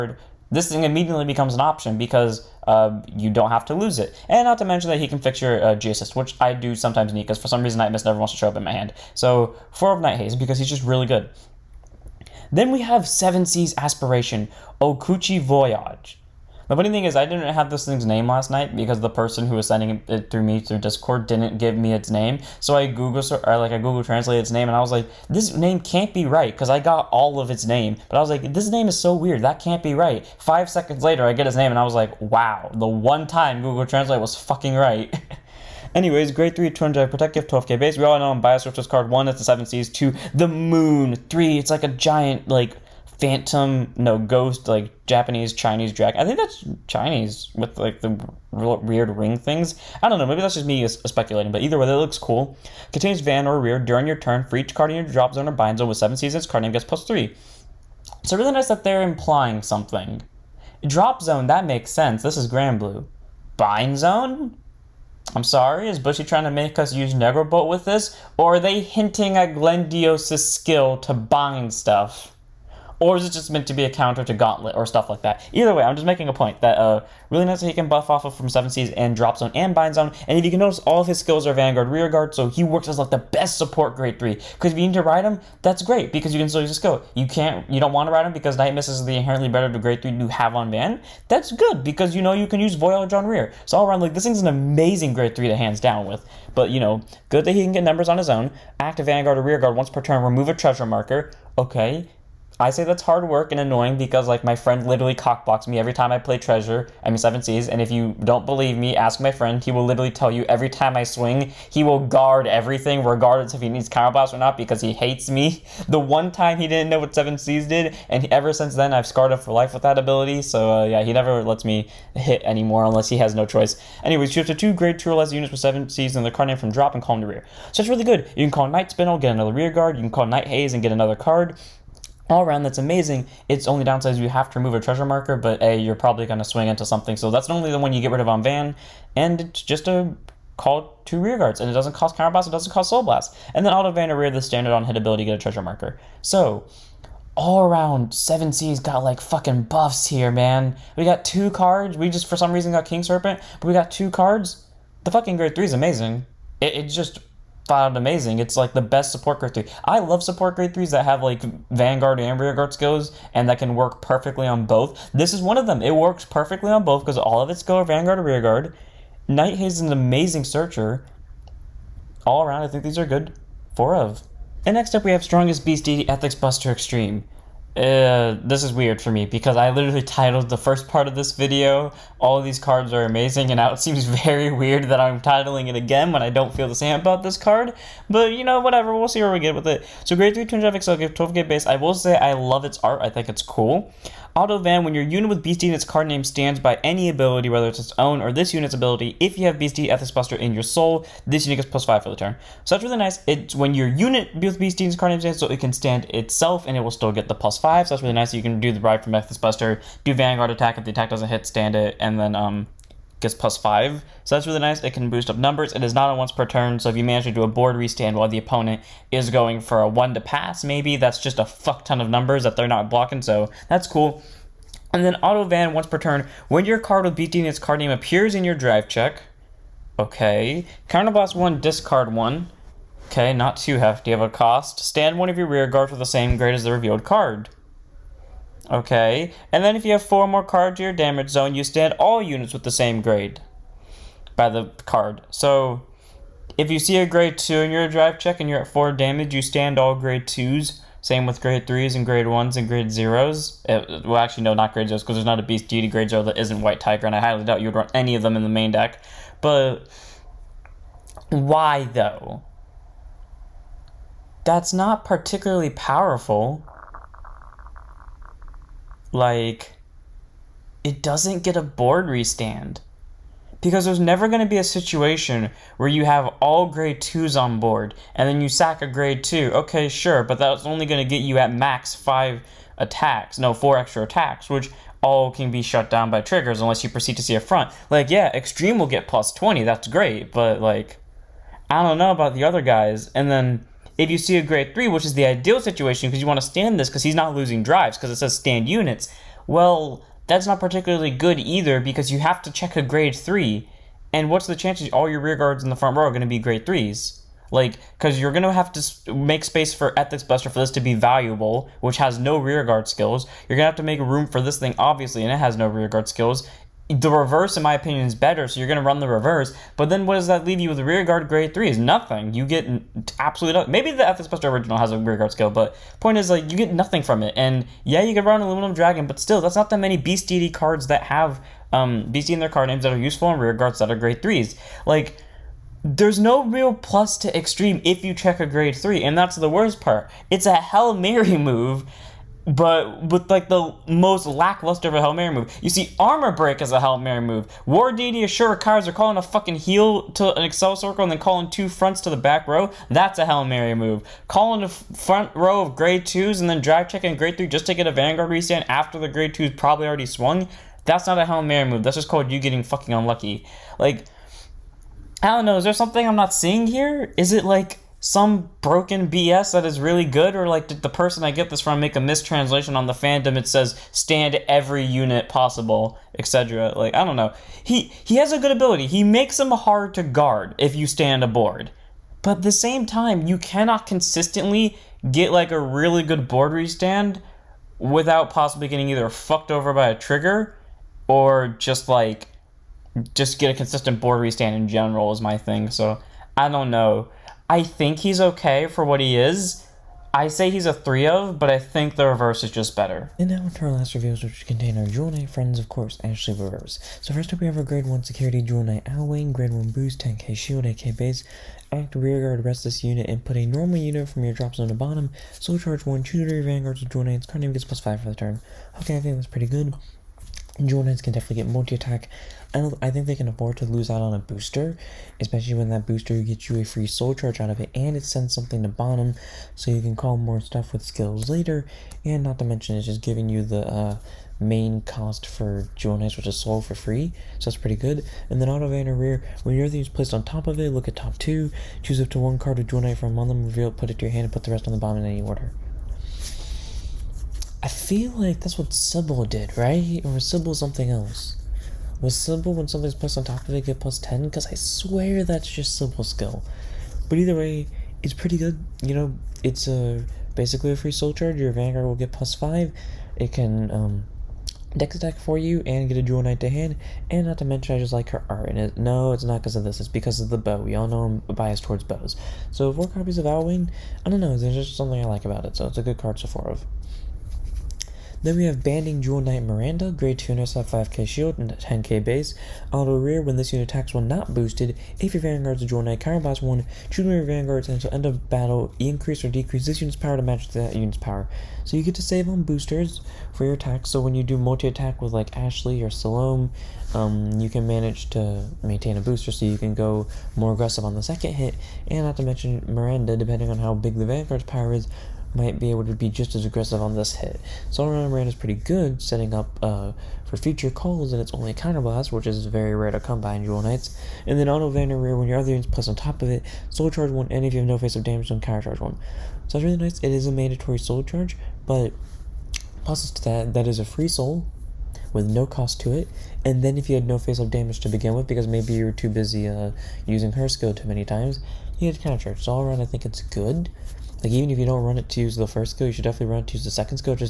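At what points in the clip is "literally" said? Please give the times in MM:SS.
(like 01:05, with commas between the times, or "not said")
01:44, 01:49, 02:59.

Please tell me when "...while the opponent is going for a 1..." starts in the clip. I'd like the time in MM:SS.
03:38.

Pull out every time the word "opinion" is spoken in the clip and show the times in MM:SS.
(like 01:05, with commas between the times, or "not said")
05:17.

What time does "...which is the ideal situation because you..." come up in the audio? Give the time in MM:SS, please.
04:54.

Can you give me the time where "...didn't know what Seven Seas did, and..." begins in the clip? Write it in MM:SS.
01:56.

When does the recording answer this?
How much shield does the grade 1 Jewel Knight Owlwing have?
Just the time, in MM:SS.
06:49.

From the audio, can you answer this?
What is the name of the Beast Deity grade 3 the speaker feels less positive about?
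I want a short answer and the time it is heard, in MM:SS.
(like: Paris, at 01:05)
Ethics Buster Extreme, at 02:55.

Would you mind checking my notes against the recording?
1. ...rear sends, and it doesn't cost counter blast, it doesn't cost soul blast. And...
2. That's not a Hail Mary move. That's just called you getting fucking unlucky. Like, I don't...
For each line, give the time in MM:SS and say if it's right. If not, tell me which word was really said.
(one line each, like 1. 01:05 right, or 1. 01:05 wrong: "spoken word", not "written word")
1. 02:21 wrong: "guards", not "sends"
2. 06:00 right.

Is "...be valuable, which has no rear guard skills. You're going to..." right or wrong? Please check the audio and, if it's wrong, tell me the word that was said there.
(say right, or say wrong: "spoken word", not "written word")
right.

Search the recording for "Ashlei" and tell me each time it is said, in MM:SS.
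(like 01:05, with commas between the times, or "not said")
06:46, 08:15.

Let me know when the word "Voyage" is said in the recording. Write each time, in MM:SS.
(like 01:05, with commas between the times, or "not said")
00:15, 01:32.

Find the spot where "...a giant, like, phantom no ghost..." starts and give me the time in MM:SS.
00:41.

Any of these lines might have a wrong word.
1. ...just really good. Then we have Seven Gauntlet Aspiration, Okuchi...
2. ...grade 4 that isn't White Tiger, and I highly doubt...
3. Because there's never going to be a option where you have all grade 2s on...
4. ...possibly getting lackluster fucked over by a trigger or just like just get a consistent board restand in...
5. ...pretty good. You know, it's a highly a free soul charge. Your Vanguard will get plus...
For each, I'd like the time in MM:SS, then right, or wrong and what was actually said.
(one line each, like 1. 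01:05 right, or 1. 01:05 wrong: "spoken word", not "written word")
1. 00:10 wrong: "Seas", not "Gauntlet"
2. 04:15 wrong: "0", not "4"
3. 04:33 wrong: "situation", not "option"
4. 06:28 wrong: "either", not "lackluster"
5. 07:38 wrong: "basically", not "highly".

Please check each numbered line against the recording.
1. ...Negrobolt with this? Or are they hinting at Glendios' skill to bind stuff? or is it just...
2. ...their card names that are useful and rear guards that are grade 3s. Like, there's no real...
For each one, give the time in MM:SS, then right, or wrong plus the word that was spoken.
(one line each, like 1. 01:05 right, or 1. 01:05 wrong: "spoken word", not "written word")
1. 01:07 right
2. 05:32 right.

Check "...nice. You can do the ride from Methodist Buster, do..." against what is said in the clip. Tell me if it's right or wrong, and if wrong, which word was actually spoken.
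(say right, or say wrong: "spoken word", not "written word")
right.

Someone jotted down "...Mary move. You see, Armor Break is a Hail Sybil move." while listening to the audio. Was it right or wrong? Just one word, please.
wrong.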